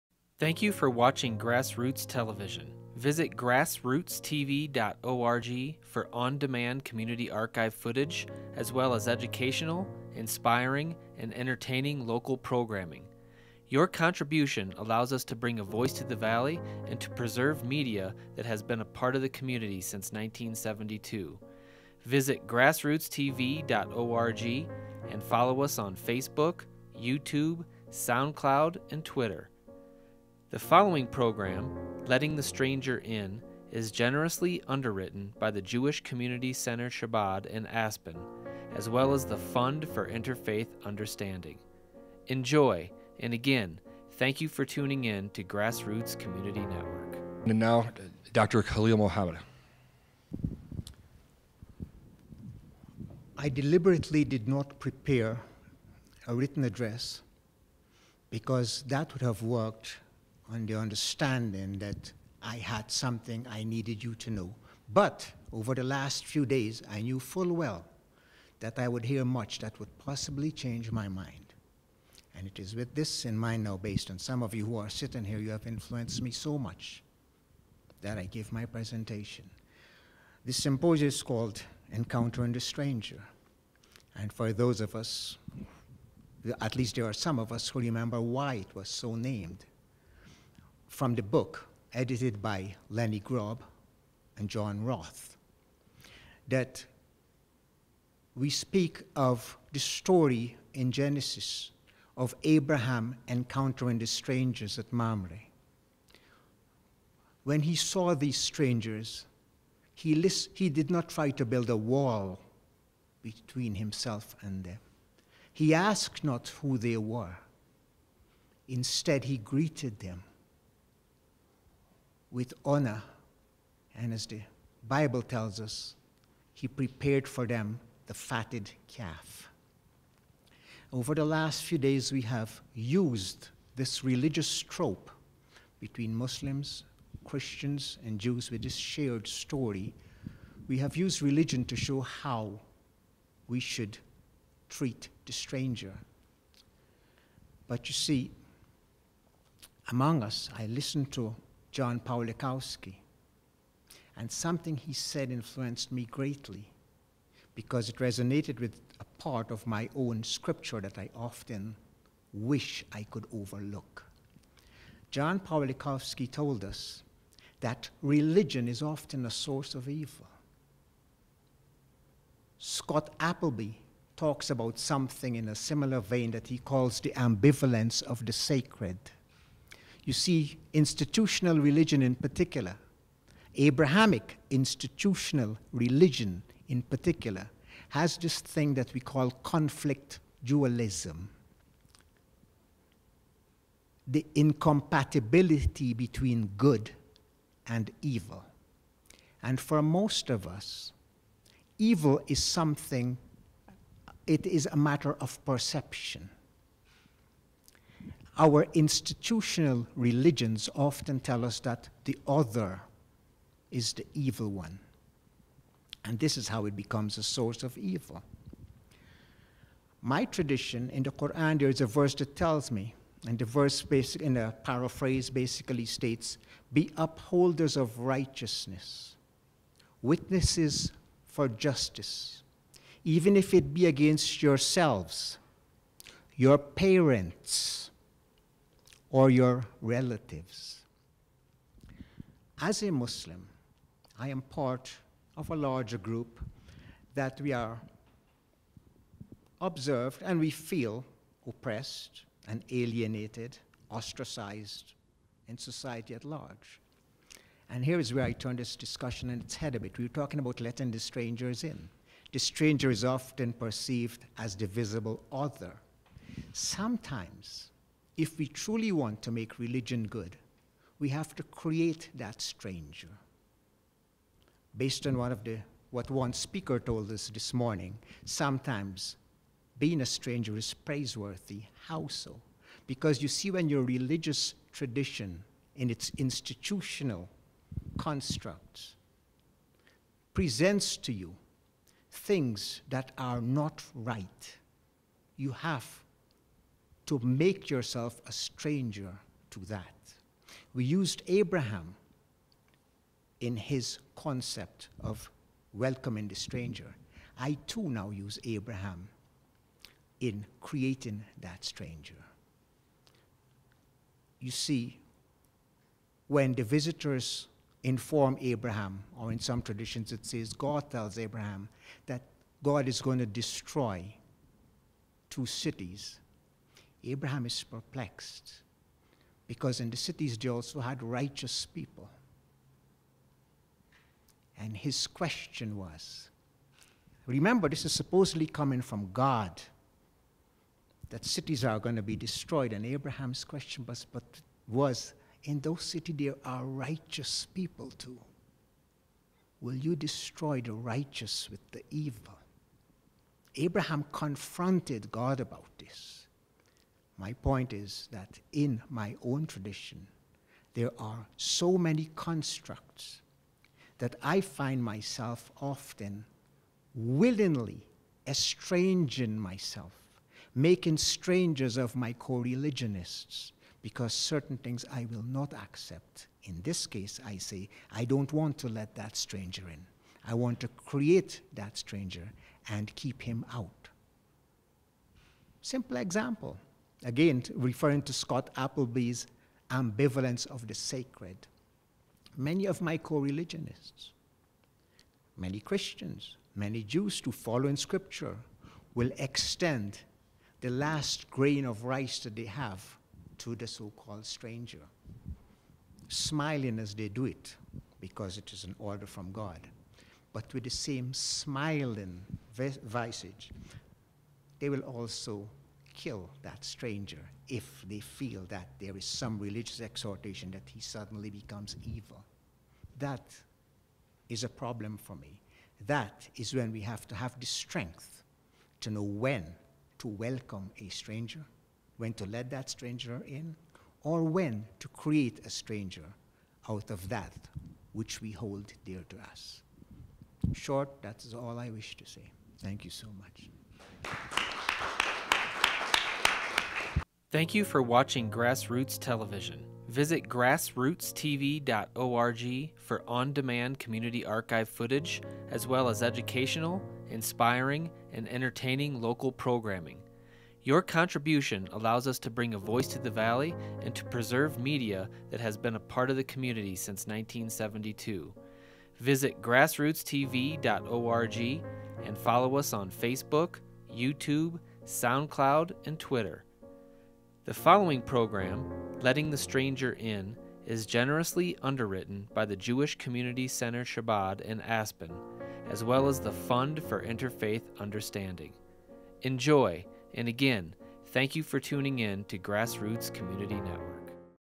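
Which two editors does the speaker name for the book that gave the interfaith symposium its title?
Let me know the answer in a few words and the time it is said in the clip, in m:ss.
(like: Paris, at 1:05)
Lenny Grob and John Roth, at 1:32.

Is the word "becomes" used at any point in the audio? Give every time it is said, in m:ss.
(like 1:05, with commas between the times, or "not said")
3:36, 7:01.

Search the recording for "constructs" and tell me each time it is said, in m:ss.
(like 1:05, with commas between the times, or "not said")
4:47, 6:02.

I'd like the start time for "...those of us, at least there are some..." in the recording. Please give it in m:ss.
1:24.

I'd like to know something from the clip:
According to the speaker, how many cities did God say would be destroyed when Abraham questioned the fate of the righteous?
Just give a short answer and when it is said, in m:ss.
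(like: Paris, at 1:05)
2, at 5:25.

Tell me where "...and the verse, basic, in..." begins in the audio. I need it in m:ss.
3:43.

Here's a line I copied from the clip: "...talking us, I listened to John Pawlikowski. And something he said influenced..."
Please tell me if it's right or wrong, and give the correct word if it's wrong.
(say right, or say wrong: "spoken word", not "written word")
wrong: "among", not "talking".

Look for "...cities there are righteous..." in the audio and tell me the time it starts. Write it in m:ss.
5:45.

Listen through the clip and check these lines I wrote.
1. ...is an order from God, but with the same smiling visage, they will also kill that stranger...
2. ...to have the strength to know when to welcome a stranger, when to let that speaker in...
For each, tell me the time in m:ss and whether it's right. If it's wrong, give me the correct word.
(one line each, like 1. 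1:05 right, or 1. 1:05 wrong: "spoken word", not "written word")
1. 6:48 right
2. 7:07 wrong: "stranger", not "speaker".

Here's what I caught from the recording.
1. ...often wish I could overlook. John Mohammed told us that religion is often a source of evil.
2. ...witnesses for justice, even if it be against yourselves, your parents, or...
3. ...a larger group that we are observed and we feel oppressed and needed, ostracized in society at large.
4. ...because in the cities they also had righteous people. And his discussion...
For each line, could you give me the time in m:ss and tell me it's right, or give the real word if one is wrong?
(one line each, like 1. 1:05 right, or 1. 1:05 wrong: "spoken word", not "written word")
1. 2:41 wrong: "Pawlikowski", not "Mohammed"
2. 3:50 right
3. 4:05 wrong: "alienated", not "needed"
4. 5:29 wrong: "question", not "discussion".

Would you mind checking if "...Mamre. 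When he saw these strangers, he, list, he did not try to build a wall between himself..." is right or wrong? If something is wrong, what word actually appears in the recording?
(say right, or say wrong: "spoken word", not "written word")
right.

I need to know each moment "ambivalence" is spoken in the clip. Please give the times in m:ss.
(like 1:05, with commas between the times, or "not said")
2:57, 6:29.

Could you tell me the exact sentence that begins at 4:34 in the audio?
Based on one of the, what one speaker told us this morning, sometimes being a stranger is praiseworthy.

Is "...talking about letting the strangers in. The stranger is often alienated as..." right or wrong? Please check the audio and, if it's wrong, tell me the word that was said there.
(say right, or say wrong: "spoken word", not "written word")
wrong: "perceived", not "alienated".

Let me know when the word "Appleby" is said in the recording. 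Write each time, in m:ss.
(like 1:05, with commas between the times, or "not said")
2:53, 6:28.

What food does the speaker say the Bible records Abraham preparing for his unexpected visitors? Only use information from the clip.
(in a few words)
The fatted calf.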